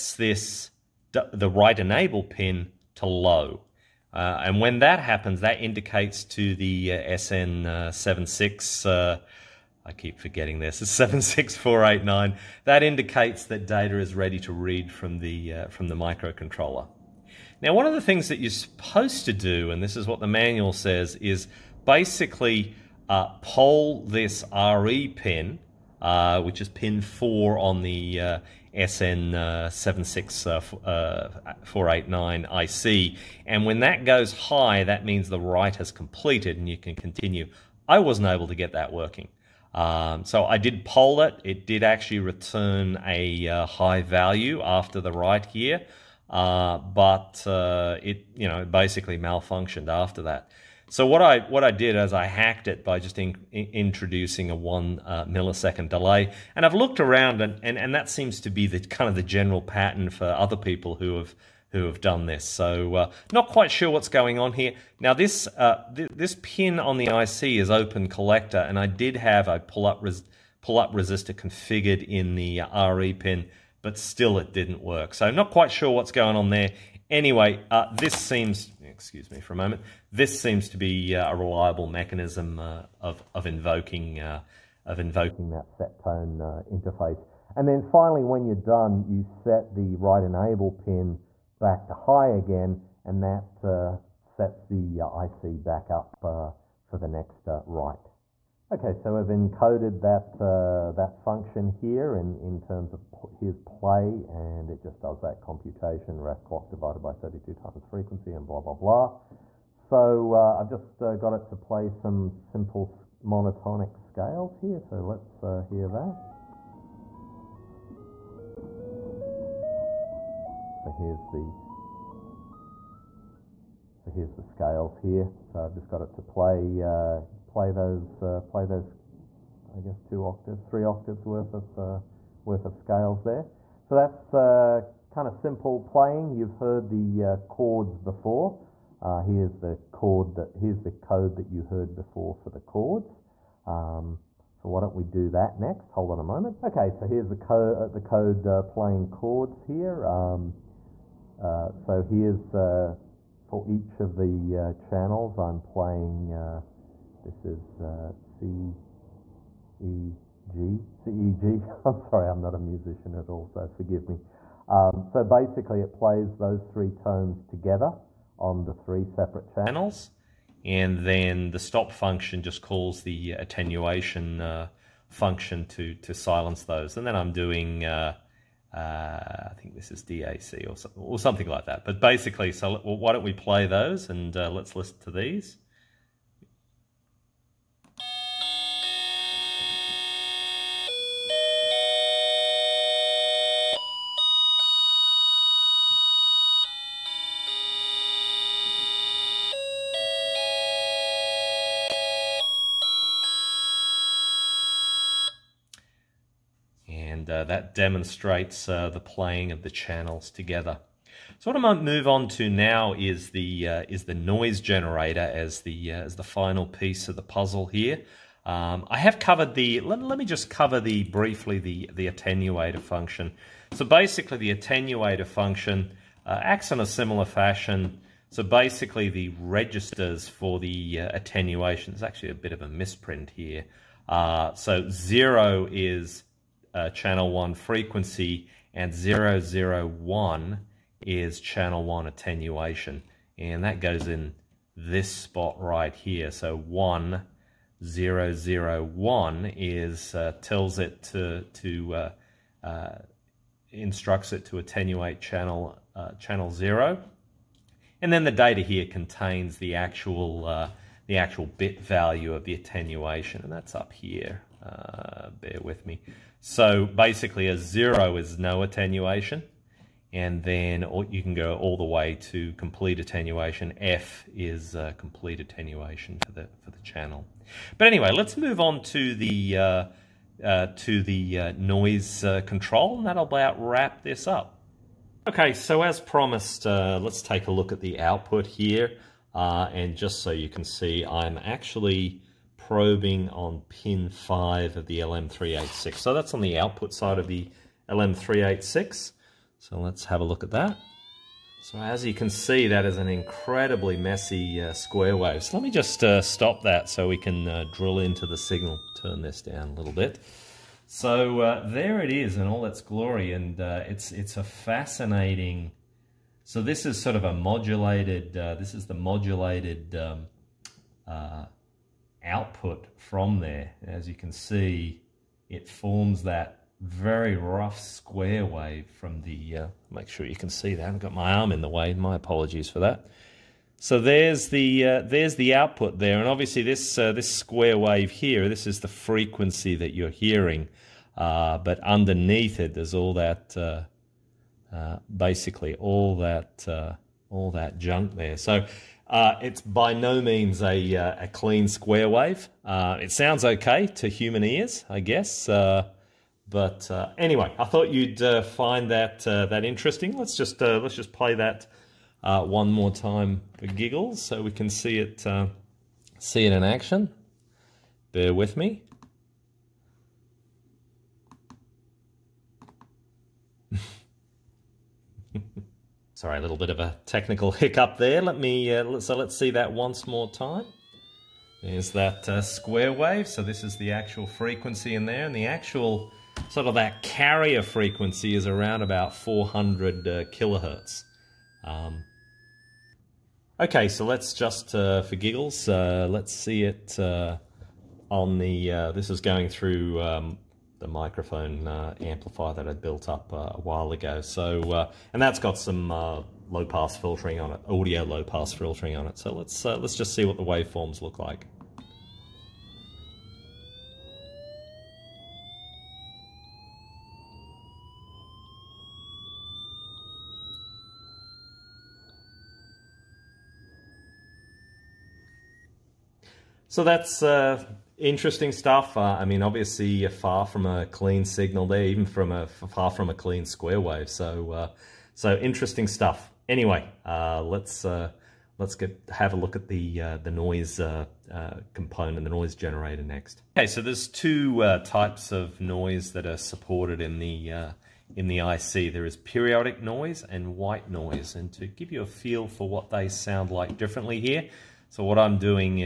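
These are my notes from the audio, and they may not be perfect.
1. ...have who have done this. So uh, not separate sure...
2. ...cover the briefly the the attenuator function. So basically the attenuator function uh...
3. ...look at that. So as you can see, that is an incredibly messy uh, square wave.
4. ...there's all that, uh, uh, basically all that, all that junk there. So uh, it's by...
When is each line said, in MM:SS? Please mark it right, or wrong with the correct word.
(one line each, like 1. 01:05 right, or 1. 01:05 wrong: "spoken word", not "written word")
1. 01:01 wrong: "quite", not "separate"
2. 03:40 right
3. 05:00 right
4. 05:42 right.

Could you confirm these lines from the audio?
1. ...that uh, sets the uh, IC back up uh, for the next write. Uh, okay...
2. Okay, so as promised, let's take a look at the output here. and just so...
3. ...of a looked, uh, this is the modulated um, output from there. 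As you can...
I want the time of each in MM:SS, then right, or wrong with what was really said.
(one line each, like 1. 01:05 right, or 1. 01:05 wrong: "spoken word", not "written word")
1. 01:33 right
2. 04:45 right
3. 05:17 wrong: "modulated", not "looked".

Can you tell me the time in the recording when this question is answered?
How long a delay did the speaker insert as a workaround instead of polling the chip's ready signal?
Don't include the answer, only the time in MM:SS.
00:54.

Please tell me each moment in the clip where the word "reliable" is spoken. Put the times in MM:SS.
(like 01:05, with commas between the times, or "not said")
01:21.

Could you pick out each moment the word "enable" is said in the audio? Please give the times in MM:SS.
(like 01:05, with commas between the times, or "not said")
00:01, 01:30.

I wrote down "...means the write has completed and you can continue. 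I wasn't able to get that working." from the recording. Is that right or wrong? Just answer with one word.
right.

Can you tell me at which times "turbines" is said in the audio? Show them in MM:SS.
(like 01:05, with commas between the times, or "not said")
not said.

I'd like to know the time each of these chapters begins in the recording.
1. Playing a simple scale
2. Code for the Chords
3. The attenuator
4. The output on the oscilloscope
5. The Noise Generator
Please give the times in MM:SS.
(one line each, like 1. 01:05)
1. 01:50
2. 02:25
3. 03:40
4. 04:44
5. 07:22.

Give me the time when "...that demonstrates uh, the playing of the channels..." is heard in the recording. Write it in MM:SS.
03:27.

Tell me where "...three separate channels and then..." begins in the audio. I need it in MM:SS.
02:48.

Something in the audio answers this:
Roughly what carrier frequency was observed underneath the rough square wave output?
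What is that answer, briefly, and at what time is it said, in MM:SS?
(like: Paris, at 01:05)
400 kilohertz, at 06:29.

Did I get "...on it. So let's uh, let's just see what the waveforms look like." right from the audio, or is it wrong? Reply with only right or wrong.
right.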